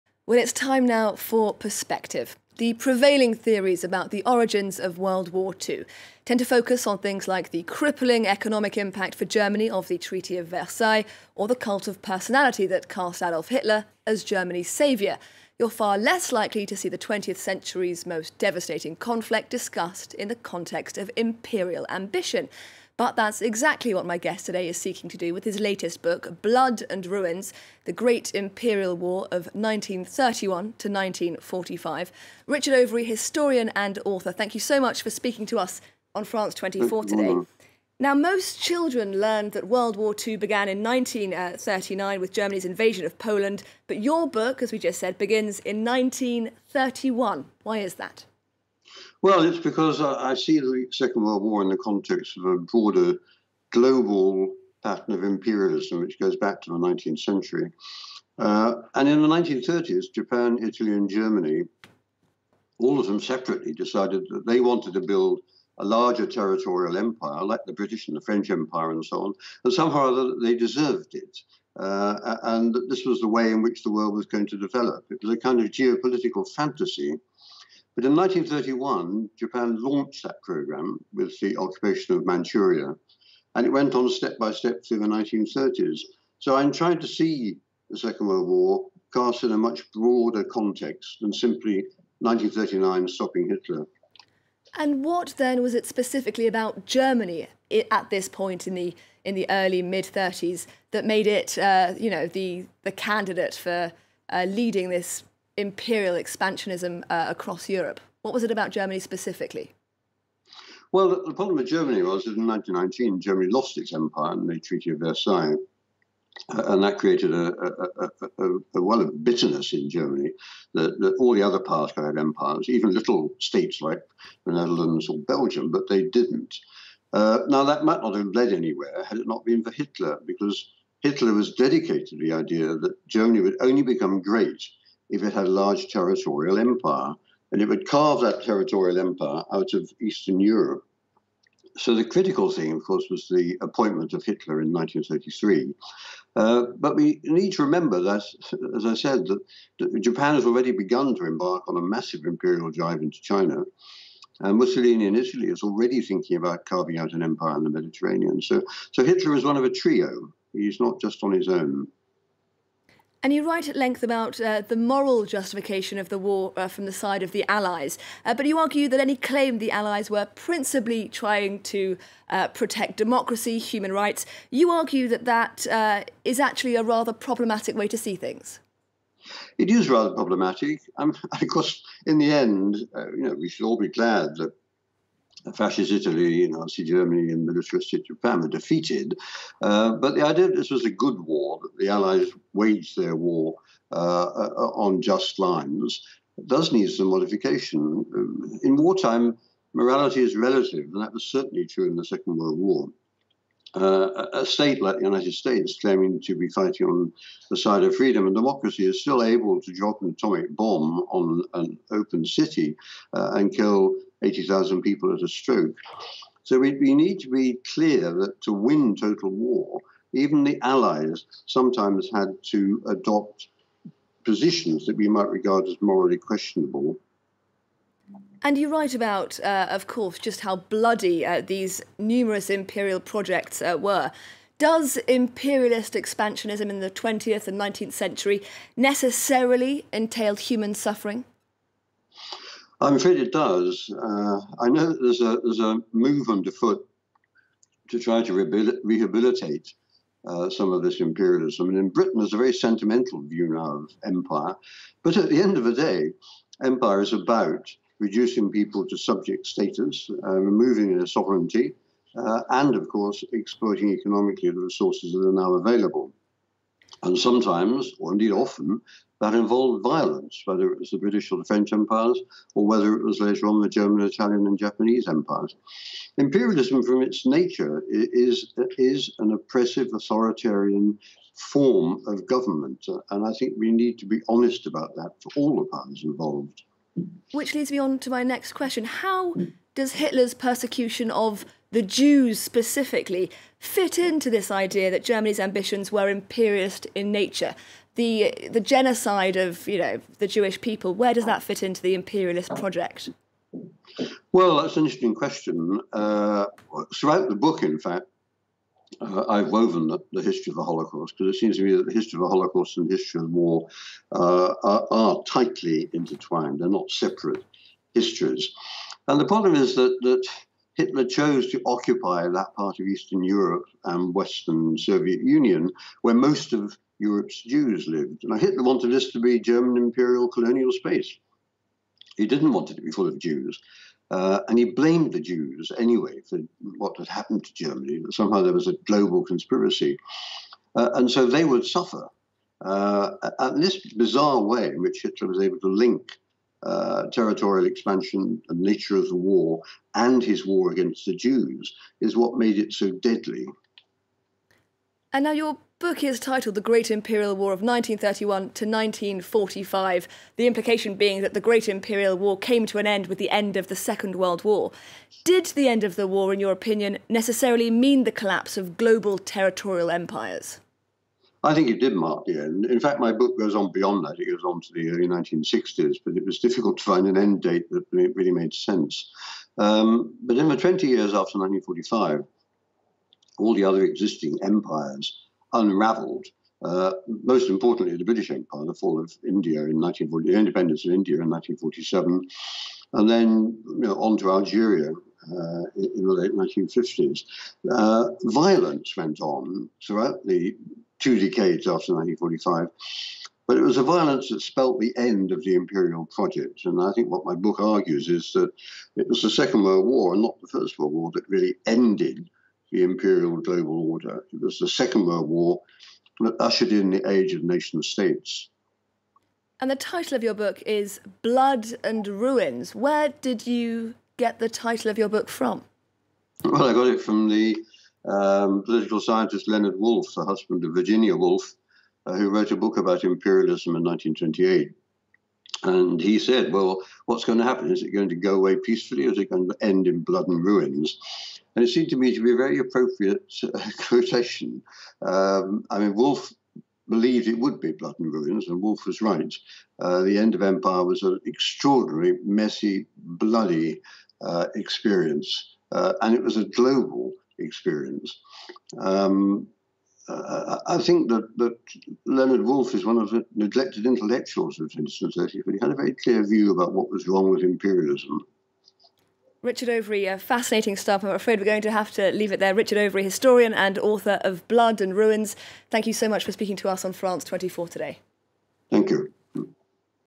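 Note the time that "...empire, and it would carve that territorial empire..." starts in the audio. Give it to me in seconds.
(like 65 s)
136 s.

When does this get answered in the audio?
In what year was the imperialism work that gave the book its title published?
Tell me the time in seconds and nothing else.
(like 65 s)
433 s.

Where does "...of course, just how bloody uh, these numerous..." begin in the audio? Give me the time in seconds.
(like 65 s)
229 s.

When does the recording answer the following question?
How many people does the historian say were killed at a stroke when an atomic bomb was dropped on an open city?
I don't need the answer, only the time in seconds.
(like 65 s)
214 s.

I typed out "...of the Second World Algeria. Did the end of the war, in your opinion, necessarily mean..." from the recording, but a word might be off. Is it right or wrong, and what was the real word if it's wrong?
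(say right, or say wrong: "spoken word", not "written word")
wrong: "War", not "Algeria".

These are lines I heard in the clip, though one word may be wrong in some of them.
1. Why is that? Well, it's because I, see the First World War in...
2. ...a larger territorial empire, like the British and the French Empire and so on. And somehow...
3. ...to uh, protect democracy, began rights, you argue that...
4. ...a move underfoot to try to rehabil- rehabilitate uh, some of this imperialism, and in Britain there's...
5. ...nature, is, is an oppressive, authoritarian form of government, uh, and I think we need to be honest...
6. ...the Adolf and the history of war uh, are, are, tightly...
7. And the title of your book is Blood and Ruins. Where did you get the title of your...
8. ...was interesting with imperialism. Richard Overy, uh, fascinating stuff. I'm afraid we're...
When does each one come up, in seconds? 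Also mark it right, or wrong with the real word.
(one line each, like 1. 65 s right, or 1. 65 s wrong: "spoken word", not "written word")
1. 47 s wrong: "Second", not "First"
2. 65 s right
3. 171 s wrong: "human", not "began"
4. 245 s right
5. 277 s right
6. 312 s wrong: "Holocaust", not "Adolf"
7. 419 s right
8. 466 s wrong: "wrong", not "interesting".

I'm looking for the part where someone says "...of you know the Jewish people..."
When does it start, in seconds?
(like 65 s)
299 s.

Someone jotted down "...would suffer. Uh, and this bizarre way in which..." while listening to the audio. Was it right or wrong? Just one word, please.
right.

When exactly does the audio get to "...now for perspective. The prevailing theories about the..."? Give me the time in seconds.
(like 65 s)
0 s.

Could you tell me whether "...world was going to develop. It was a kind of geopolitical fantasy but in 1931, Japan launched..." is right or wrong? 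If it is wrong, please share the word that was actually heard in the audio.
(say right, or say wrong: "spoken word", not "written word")
right.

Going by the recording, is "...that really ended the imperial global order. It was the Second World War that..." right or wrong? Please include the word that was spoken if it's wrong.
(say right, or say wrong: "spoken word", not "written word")
right.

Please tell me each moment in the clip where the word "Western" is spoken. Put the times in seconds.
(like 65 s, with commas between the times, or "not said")
324 s.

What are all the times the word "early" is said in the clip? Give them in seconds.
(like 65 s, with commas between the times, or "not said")
99 s, 374 s.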